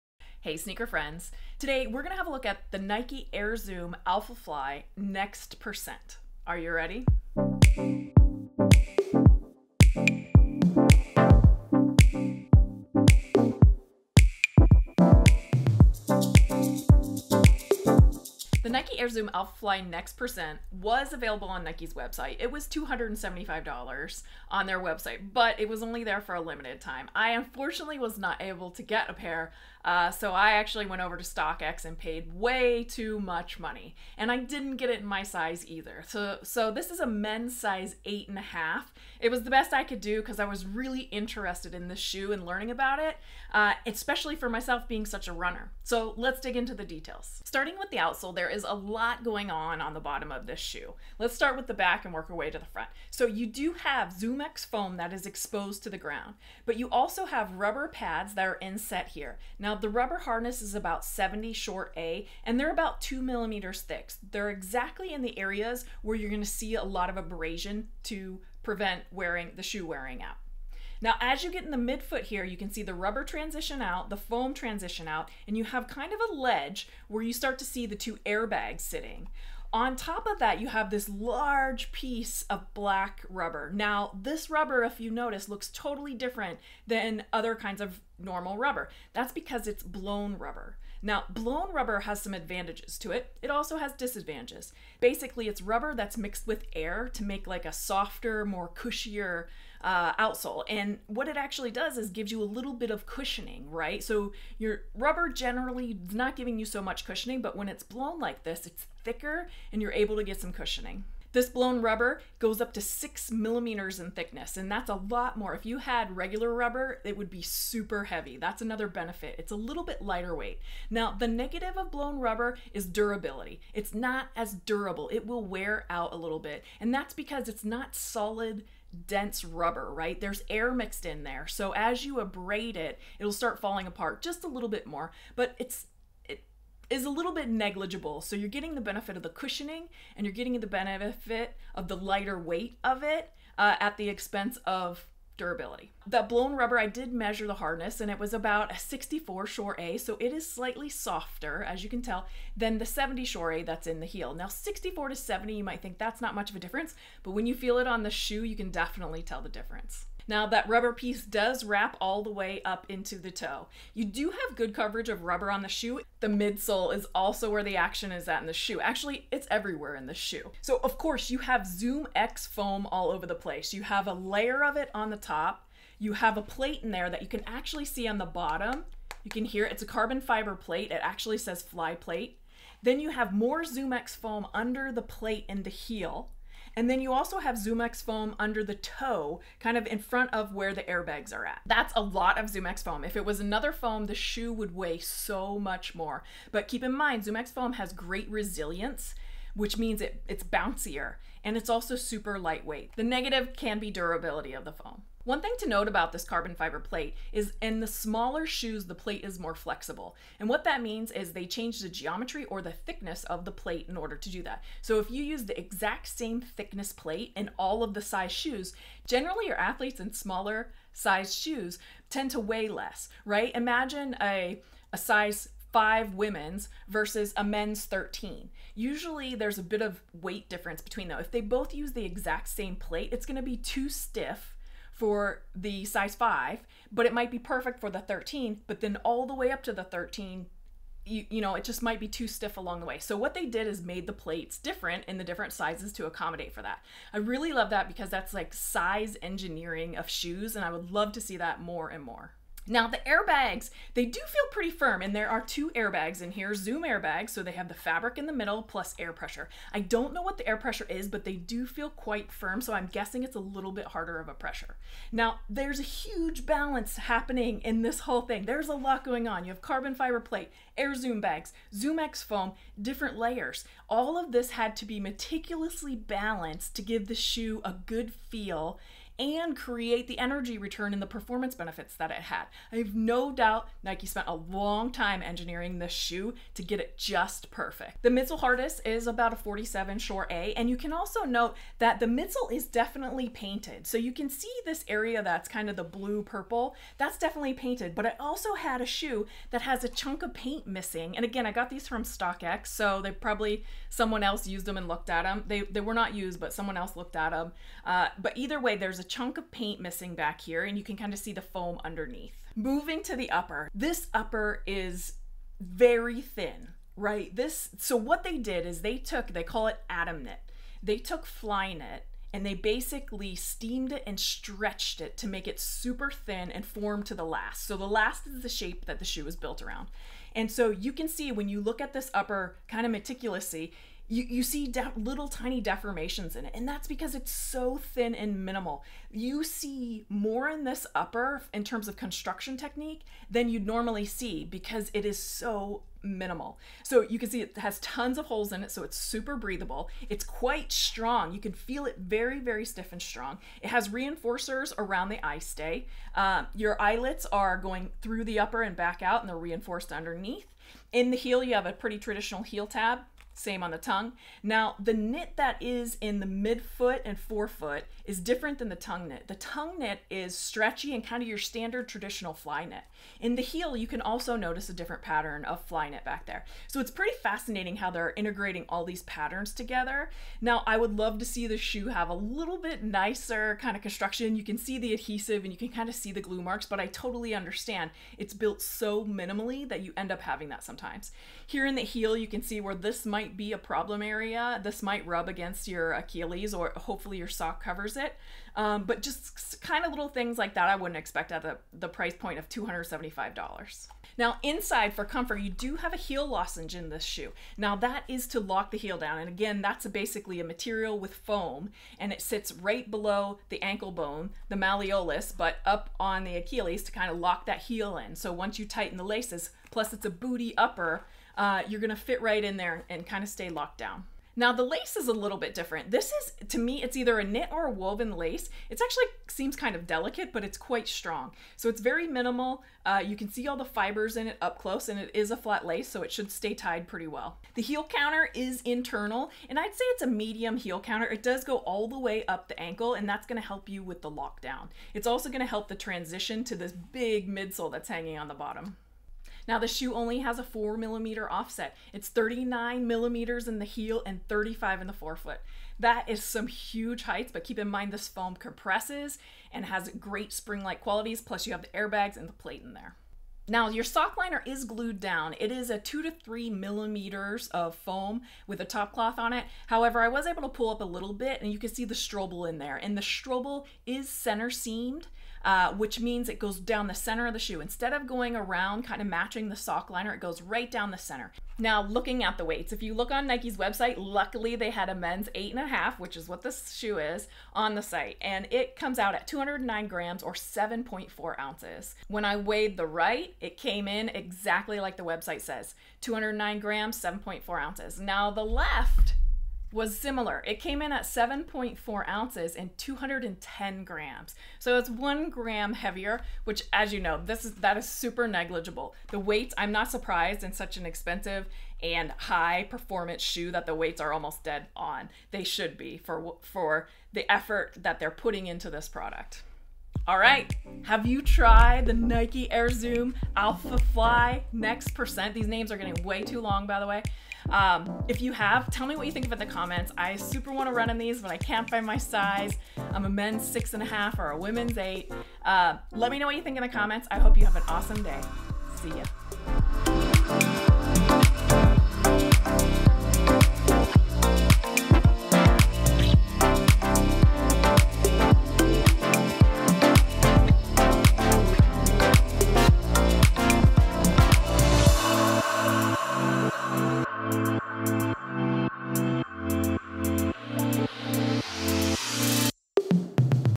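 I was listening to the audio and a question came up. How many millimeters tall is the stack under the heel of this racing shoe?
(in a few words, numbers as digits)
39 millimeters.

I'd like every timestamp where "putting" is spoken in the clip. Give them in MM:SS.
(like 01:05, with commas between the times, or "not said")
08:38.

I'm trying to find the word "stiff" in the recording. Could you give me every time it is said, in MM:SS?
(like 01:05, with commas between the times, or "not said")
03:53, 04:02, 05:52.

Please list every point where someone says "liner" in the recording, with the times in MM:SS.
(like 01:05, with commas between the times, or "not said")
07:44, 07:59.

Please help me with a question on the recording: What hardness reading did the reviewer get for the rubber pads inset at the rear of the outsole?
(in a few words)
70 Shore A.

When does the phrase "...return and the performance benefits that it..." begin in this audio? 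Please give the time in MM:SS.
04:40.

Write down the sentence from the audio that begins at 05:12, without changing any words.
Moving to the upper, this upper is very thin, right?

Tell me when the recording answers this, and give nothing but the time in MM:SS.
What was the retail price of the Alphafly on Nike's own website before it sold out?
00:22.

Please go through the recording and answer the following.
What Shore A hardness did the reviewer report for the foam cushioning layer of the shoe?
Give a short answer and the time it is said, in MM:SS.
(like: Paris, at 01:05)
47 Shore A, at 04:49.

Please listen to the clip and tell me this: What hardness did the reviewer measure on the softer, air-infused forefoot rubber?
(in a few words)
64 Shore A.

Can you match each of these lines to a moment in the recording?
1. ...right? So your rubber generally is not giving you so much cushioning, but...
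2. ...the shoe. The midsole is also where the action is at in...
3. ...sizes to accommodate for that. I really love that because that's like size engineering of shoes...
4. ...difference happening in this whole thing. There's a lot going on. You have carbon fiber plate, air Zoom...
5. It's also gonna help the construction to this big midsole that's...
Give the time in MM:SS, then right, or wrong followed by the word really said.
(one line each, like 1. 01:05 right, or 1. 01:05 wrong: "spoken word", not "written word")
1. 01:43 right
2. 02:45 right
3. 04:05 right
4. 04:26 wrong: "balance", not "difference"
5. 07:24 wrong: "transition", not "construction".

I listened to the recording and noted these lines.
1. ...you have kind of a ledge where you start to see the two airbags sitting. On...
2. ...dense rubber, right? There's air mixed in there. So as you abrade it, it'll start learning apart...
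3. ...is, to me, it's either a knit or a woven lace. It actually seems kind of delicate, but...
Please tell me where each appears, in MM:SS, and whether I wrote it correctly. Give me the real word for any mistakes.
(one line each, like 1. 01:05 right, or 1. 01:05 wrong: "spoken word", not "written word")
1. 01:15 right
2. 02:09 wrong: "falling", not "learning"
3. 07:06 right.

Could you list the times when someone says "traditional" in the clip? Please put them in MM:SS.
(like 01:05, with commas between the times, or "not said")
06:01, 06:11.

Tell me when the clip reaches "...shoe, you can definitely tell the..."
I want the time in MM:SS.
02:38.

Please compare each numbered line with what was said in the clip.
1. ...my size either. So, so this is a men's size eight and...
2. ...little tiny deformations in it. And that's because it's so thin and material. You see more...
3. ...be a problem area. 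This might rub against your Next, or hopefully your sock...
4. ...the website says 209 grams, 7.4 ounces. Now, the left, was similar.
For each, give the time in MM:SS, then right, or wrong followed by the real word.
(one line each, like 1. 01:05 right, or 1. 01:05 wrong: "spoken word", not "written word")
1. 00:35 right
2. 05:34 wrong: "minimal", not "material"
3. 06:33 wrong: "Achilles", not "Next"
4. 08:14 right.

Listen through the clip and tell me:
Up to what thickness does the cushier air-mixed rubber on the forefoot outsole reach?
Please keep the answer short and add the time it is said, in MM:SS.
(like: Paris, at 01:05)
6 millimeters, at 01:52.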